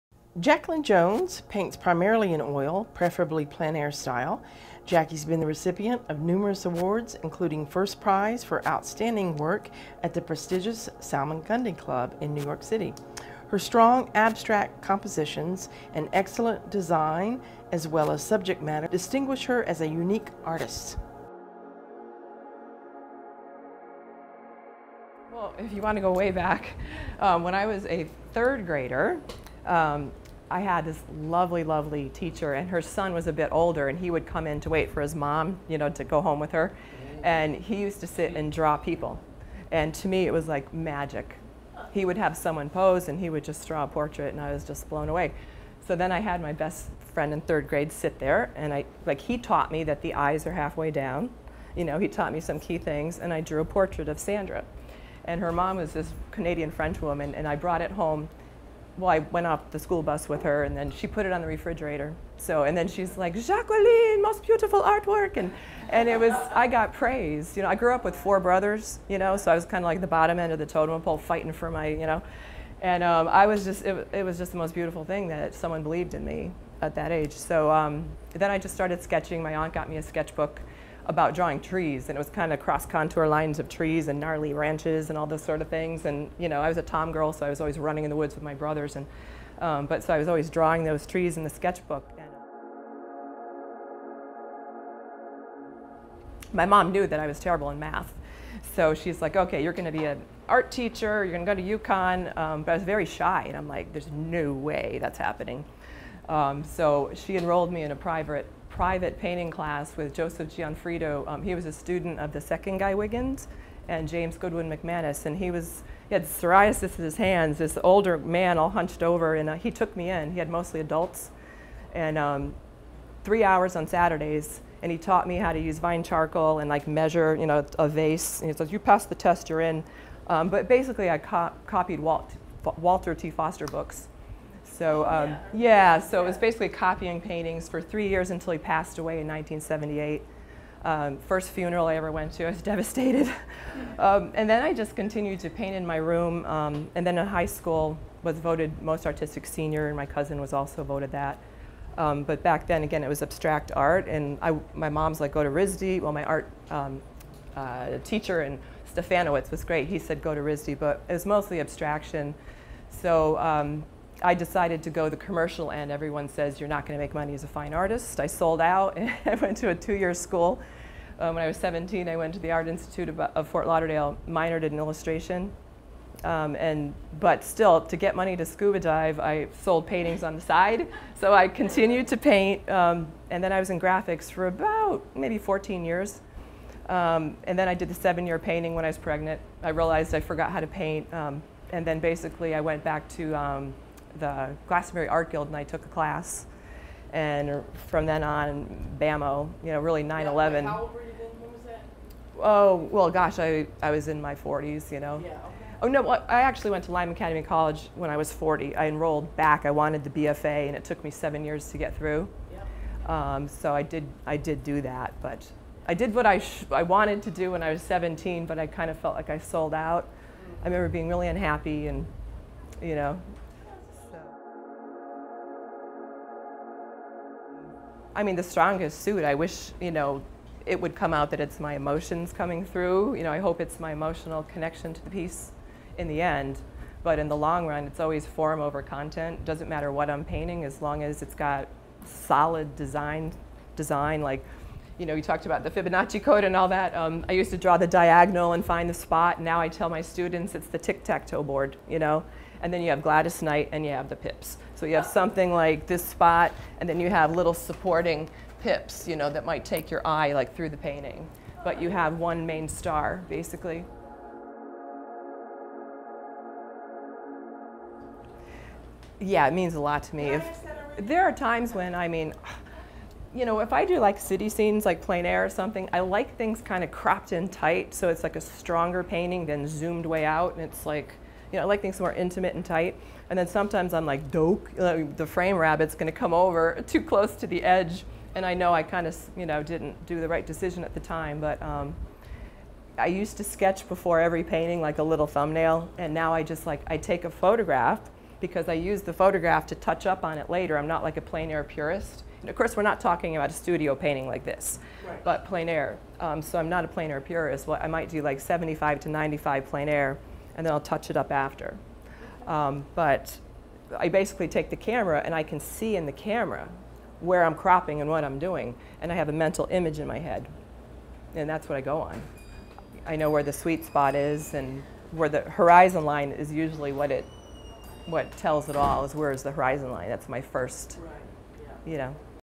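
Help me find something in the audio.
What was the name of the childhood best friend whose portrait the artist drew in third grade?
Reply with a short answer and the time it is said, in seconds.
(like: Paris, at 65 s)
Sandra, at 54 s.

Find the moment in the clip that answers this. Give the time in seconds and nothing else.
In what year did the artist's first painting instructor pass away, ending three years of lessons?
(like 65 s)
139 s.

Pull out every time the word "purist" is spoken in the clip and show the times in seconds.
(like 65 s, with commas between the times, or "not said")
301 s, 307 s.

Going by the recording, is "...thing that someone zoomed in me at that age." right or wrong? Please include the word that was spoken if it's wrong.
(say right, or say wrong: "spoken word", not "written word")
wrong: "believed", not "zoomed".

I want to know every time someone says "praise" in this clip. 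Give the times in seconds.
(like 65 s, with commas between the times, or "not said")
66 s.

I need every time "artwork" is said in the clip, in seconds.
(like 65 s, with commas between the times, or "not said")
64 s.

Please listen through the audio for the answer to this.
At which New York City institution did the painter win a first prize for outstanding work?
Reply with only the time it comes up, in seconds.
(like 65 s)
11 s.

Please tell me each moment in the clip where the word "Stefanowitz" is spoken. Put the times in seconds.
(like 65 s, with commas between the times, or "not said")
158 s.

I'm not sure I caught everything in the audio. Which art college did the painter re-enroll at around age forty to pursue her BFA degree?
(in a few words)
Lyme Academy College.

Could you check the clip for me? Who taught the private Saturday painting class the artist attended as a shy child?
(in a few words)
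Joseph Gianfrido.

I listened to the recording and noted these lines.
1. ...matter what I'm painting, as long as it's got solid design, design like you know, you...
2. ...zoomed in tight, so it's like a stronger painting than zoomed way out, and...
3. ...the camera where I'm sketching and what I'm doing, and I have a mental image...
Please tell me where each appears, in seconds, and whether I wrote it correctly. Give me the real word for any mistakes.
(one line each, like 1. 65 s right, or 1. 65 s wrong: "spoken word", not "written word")
1. 239 s right
2. 276 s wrong: "cropped", not "zoomed"
3. 316 s wrong: "cropping", not "sketching".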